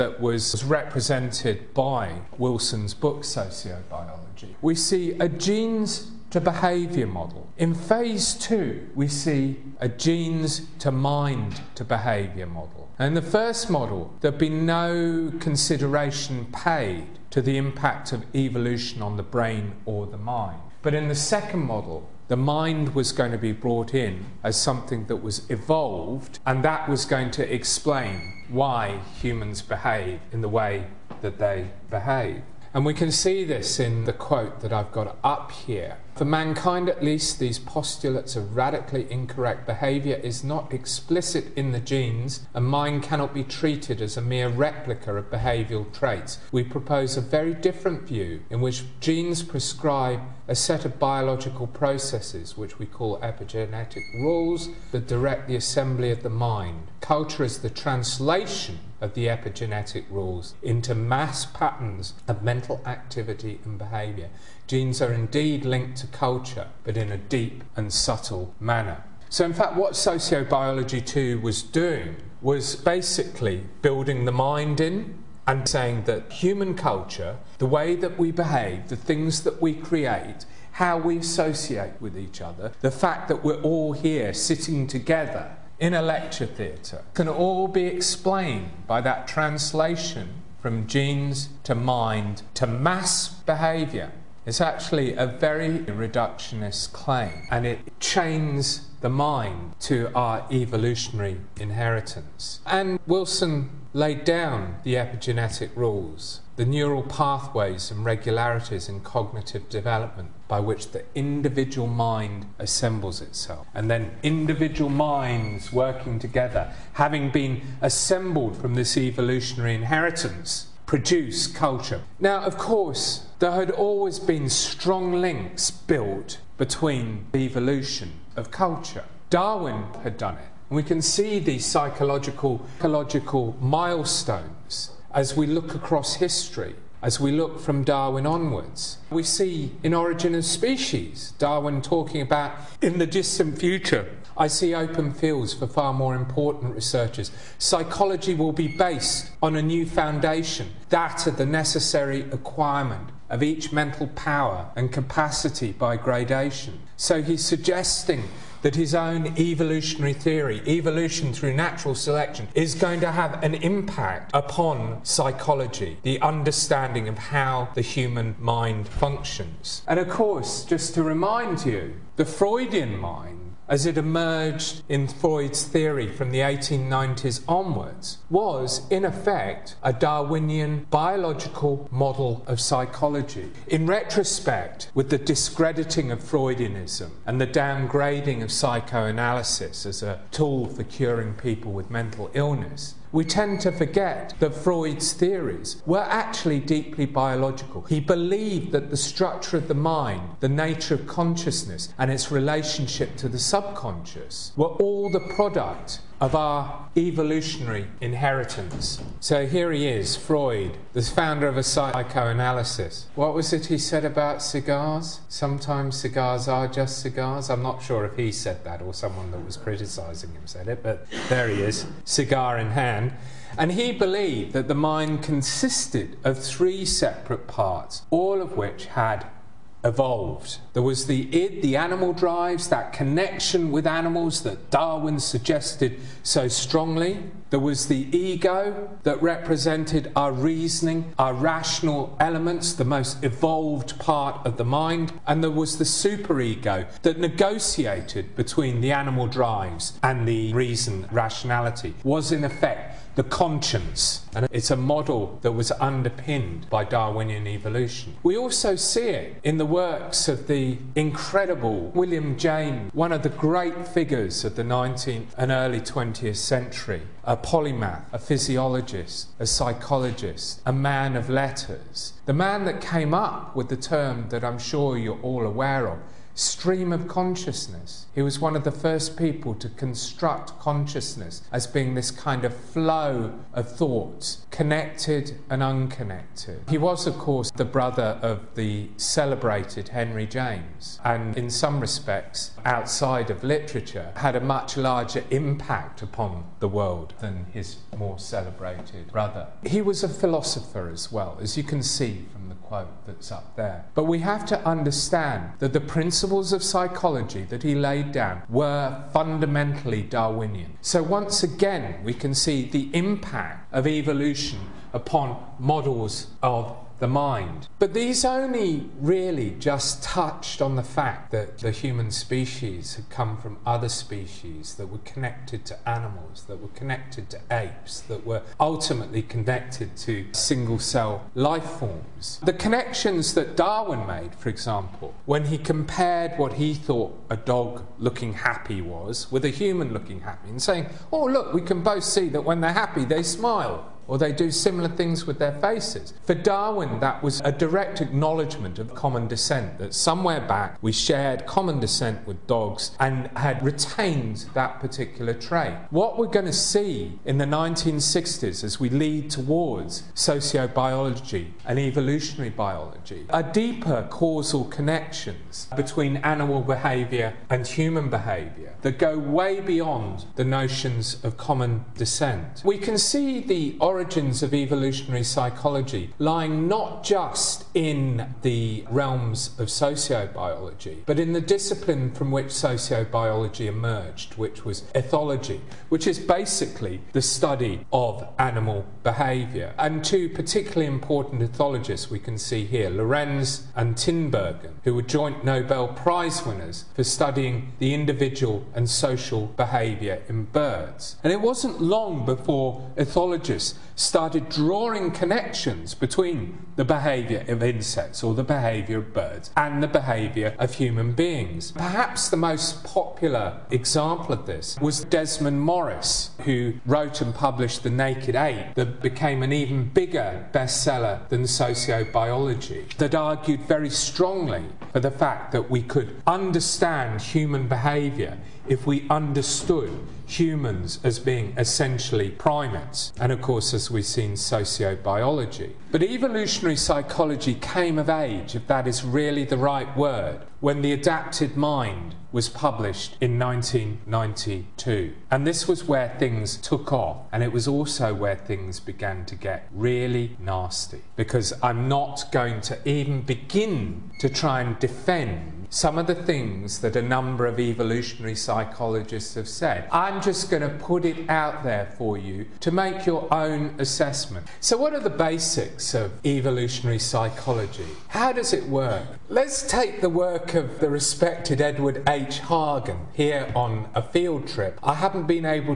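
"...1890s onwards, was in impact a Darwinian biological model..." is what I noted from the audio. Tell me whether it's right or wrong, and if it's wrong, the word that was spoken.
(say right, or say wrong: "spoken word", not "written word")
wrong: "effect", not "impact".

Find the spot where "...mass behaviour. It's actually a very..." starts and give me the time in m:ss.
1:32.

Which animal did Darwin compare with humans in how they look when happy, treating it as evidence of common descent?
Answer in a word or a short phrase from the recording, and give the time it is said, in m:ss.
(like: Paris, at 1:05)
Dog, at 5:37.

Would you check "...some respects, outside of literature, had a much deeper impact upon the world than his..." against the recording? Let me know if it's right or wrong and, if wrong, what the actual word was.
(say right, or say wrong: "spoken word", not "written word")
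wrong: "larger", not "deeper".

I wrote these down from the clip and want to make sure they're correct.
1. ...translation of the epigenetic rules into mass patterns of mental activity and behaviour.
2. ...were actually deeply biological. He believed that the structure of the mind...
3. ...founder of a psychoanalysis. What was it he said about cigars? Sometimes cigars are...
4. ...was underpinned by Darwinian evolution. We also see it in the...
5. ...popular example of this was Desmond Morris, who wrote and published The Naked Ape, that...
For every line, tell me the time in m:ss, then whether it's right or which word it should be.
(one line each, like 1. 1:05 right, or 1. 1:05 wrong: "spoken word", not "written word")
1. 0:57 right
2. 3:15 right
3. 3:31 right
4. 4:15 right
5. 6:52 right.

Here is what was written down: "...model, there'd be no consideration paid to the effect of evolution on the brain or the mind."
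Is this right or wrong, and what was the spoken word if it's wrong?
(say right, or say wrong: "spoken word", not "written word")
wrong: "impact", not "effect".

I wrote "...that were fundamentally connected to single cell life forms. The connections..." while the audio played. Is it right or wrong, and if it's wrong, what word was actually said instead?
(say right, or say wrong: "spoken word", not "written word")
wrong: "ultimately", not "fundamentally".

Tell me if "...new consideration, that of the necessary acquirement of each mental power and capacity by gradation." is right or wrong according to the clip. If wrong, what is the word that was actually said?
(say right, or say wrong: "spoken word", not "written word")
wrong: "foundation", not "consideration".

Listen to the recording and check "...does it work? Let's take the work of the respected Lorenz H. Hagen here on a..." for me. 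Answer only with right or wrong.
wrong.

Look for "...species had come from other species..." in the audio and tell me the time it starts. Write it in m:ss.
5:22.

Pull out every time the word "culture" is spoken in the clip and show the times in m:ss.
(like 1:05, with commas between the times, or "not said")
0:56, 1:06, 1:16, 2:01, 2:08.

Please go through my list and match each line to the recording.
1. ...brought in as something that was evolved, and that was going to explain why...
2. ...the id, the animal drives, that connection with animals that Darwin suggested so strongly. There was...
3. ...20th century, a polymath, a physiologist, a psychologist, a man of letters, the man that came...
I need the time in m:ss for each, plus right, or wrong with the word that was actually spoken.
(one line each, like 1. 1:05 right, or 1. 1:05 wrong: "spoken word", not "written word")
1. 0:23 right
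2. 3:51 right
3. 4:25 right.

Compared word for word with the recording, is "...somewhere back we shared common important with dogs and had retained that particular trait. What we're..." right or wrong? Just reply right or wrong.
wrong.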